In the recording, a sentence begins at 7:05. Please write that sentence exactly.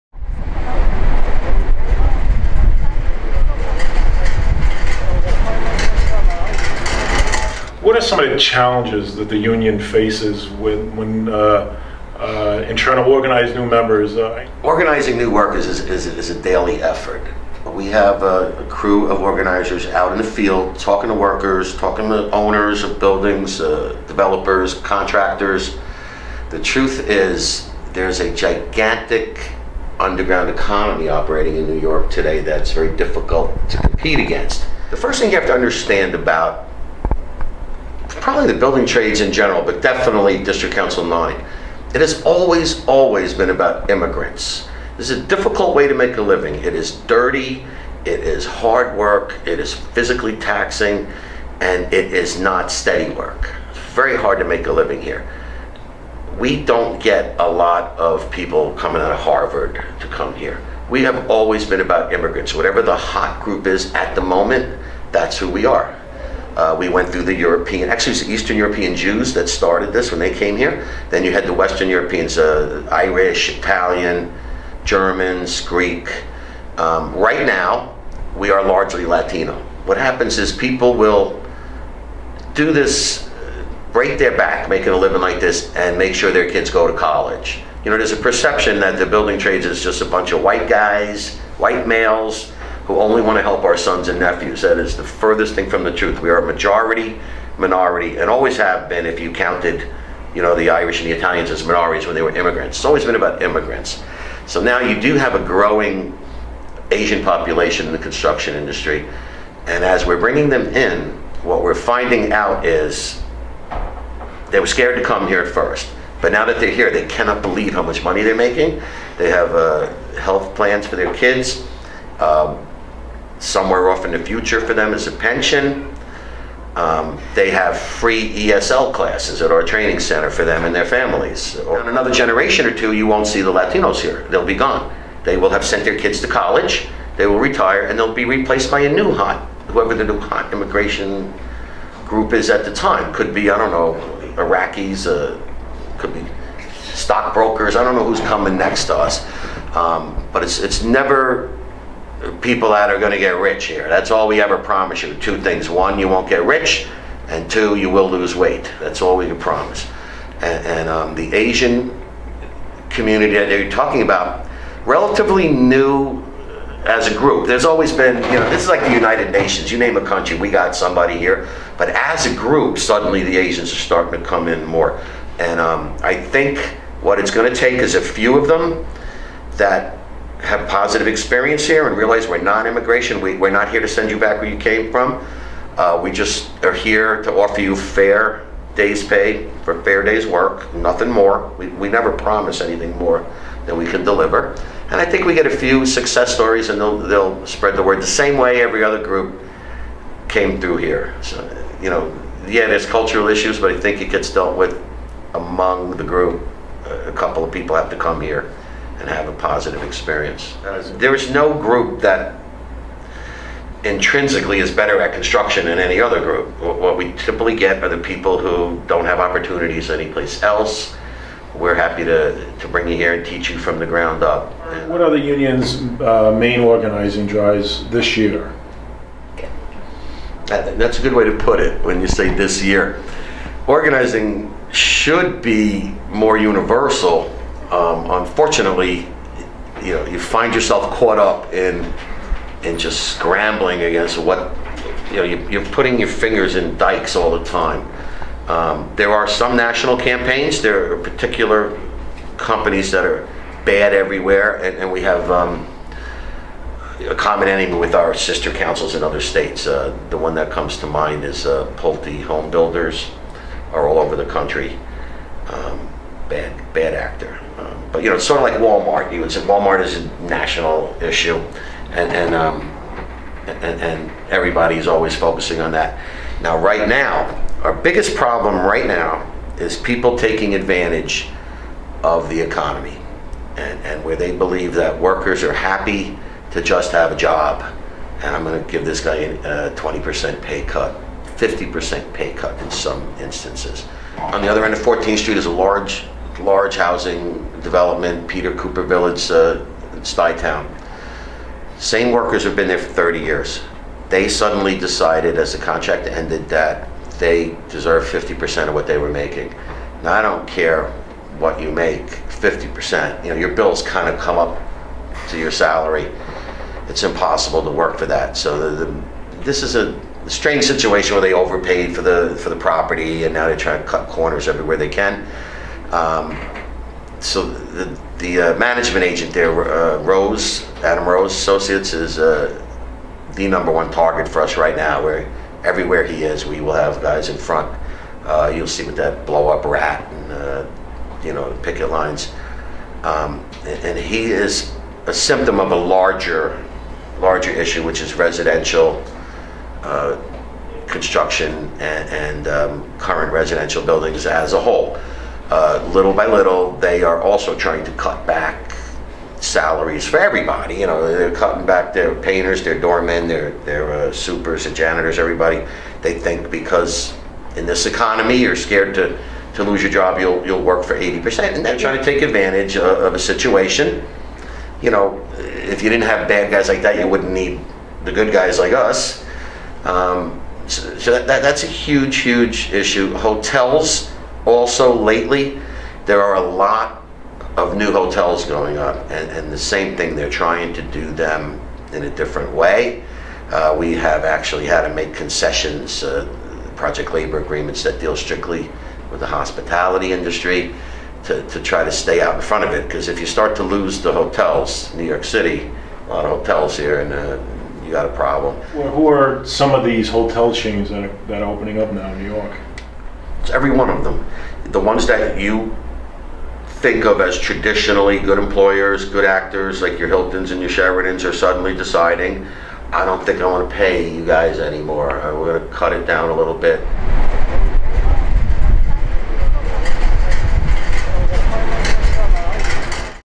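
We're going to cut it down a little bit.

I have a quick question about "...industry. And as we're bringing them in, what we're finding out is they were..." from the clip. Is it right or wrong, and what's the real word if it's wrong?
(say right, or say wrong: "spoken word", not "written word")
right.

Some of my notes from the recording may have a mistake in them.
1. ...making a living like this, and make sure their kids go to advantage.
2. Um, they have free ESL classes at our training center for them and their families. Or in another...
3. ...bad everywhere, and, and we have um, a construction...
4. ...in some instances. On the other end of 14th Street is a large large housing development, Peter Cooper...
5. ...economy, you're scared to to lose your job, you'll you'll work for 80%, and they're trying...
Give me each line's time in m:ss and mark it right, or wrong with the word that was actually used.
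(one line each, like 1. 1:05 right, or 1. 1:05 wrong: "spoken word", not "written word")
1. 1:24 wrong: "college", not "advantage"
2. 2:06 right
3. 4:13 wrong: "common", not "construction"
4. 4:52 right
5. 6:07 right.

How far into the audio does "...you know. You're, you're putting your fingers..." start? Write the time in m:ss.
4:05.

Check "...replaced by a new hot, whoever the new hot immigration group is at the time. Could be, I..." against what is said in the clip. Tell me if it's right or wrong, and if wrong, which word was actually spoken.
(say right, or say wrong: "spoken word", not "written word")
right.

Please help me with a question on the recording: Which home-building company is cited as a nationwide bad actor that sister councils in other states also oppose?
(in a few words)
Pulte Home Builders.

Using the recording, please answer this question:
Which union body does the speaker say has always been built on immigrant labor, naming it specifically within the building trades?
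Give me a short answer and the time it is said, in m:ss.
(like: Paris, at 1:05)
District Council 9, at 0:40.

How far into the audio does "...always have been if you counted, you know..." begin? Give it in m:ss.
1:38.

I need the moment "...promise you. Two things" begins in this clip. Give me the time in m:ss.
2:34.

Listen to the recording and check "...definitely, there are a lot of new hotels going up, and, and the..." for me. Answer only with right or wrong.
wrong.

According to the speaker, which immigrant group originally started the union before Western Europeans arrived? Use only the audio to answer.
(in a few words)
Eastern European Jews.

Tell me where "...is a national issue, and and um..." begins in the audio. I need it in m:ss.
4:29.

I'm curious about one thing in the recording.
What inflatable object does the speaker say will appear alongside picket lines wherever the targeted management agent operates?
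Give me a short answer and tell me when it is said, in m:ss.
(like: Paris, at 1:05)
blow up rat, at 5:39.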